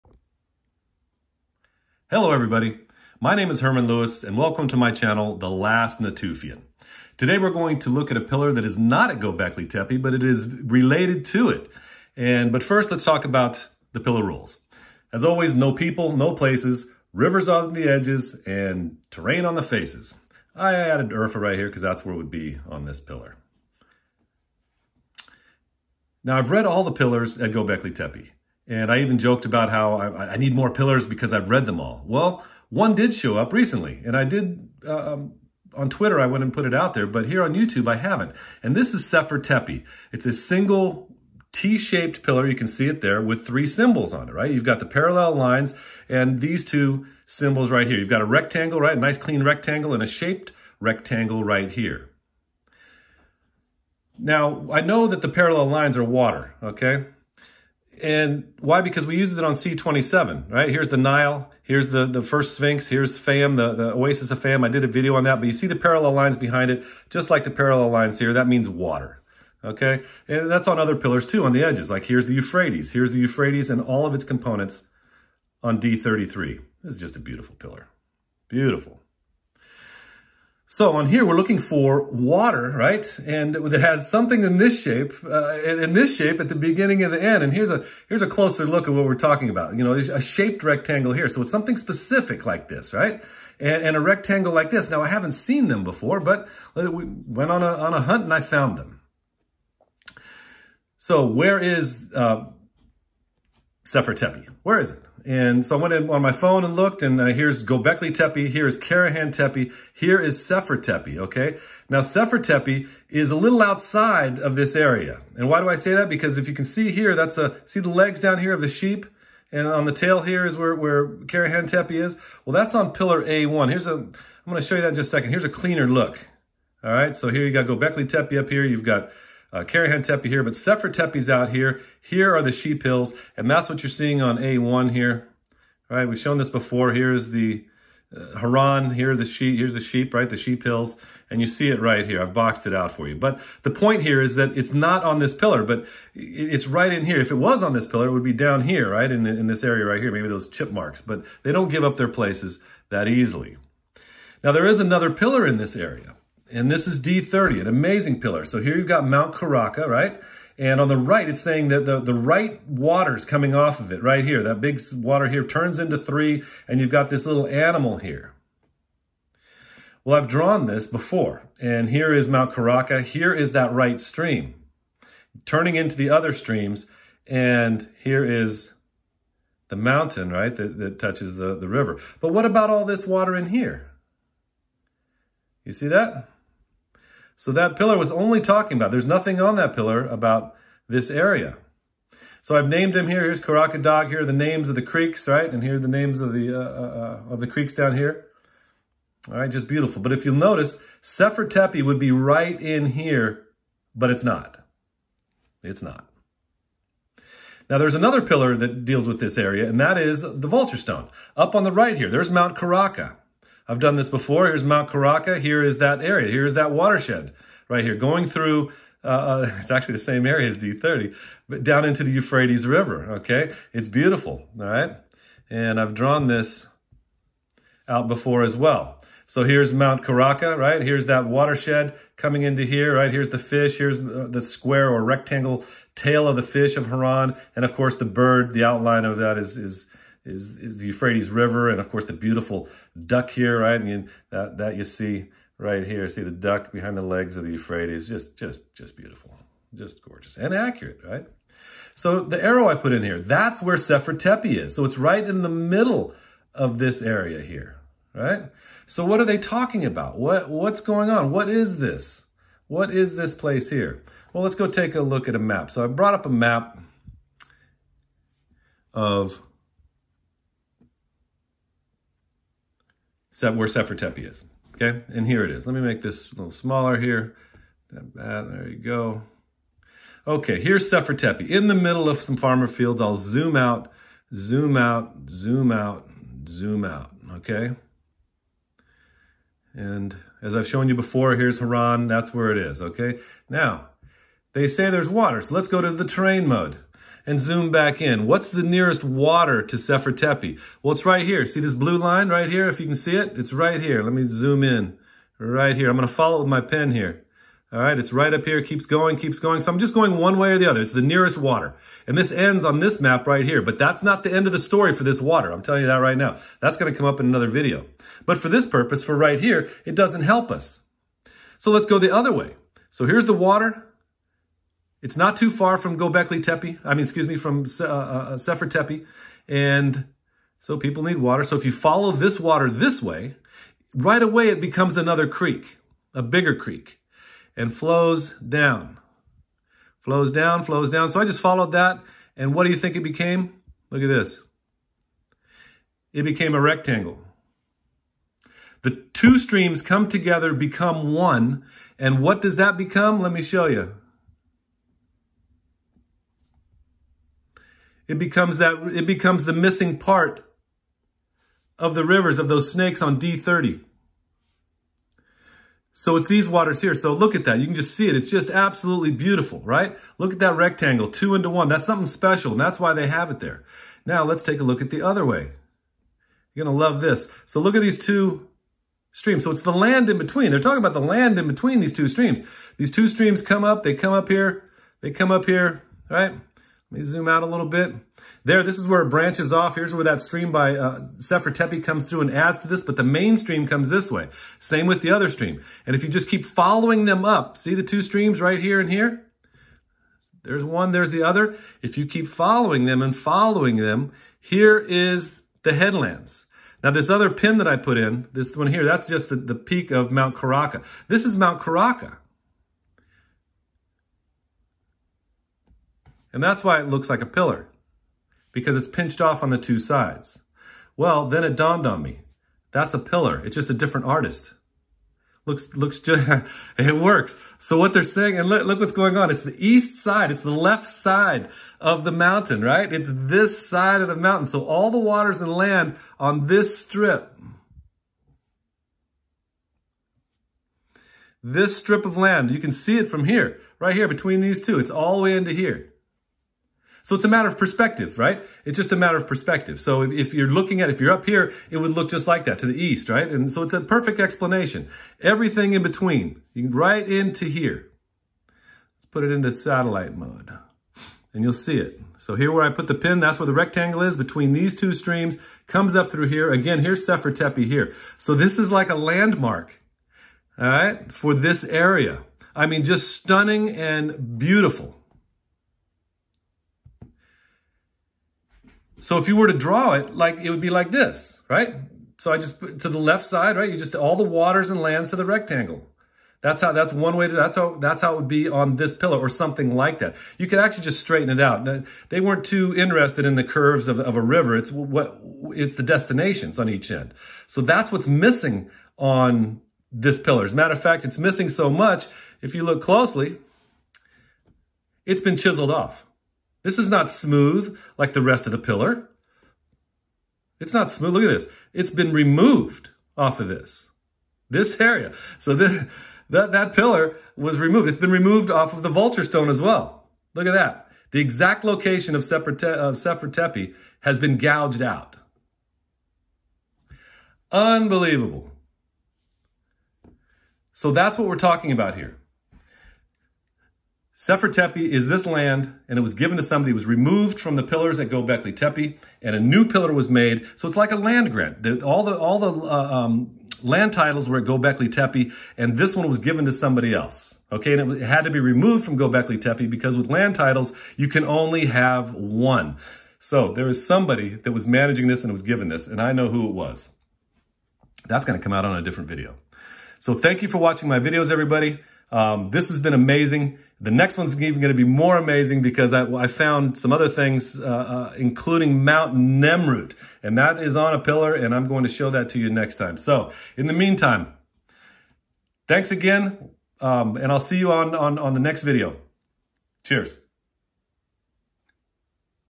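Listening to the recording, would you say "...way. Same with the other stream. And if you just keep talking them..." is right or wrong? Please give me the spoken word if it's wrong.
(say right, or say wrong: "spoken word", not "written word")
wrong: "following", not "talking".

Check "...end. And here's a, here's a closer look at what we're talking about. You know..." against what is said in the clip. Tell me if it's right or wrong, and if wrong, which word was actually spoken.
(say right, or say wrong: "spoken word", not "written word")
right.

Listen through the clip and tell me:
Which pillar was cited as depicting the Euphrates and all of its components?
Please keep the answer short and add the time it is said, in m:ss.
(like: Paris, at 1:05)
D33, at 1:15.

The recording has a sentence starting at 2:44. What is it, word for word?
That big water here turns into three, and you've got this little animal here.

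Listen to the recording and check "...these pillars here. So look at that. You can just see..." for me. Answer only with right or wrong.
wrong.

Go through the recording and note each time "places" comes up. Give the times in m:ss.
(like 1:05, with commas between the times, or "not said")
0:16, 2:32, 4:23.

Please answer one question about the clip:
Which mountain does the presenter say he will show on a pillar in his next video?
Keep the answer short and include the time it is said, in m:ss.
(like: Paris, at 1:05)
Mount Nemrut, at 9:28.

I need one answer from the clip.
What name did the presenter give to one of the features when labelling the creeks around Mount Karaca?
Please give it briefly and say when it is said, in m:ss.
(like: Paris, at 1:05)
Dog, at 3:13.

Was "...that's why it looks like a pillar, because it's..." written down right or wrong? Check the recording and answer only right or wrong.
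right.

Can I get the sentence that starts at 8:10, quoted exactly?
You could actually just straighten it out.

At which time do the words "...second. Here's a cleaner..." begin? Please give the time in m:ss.
2:05.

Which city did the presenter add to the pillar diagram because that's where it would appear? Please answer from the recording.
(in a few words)
Urfa.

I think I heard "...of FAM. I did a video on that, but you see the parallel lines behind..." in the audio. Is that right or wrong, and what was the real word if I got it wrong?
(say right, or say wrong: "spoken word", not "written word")
right.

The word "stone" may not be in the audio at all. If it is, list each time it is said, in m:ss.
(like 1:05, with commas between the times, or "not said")
3:30, 8:39.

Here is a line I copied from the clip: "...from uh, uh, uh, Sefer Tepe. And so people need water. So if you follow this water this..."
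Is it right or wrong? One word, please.
right.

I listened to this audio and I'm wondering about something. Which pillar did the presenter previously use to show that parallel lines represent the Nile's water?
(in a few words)
C27.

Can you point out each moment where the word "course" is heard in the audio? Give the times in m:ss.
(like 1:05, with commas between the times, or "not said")
3:57, 4:01.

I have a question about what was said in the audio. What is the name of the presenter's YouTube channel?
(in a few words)
The Last Natufian.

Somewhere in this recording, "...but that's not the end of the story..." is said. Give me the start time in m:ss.
5:13.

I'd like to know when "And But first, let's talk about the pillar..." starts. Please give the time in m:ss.
0:12.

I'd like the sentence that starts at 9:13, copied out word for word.
So there was somebody that was managing this and was given this, and I know who it was.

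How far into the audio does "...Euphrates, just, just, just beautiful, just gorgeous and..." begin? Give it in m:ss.
4:07.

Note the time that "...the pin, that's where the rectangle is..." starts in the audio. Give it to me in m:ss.
7:42.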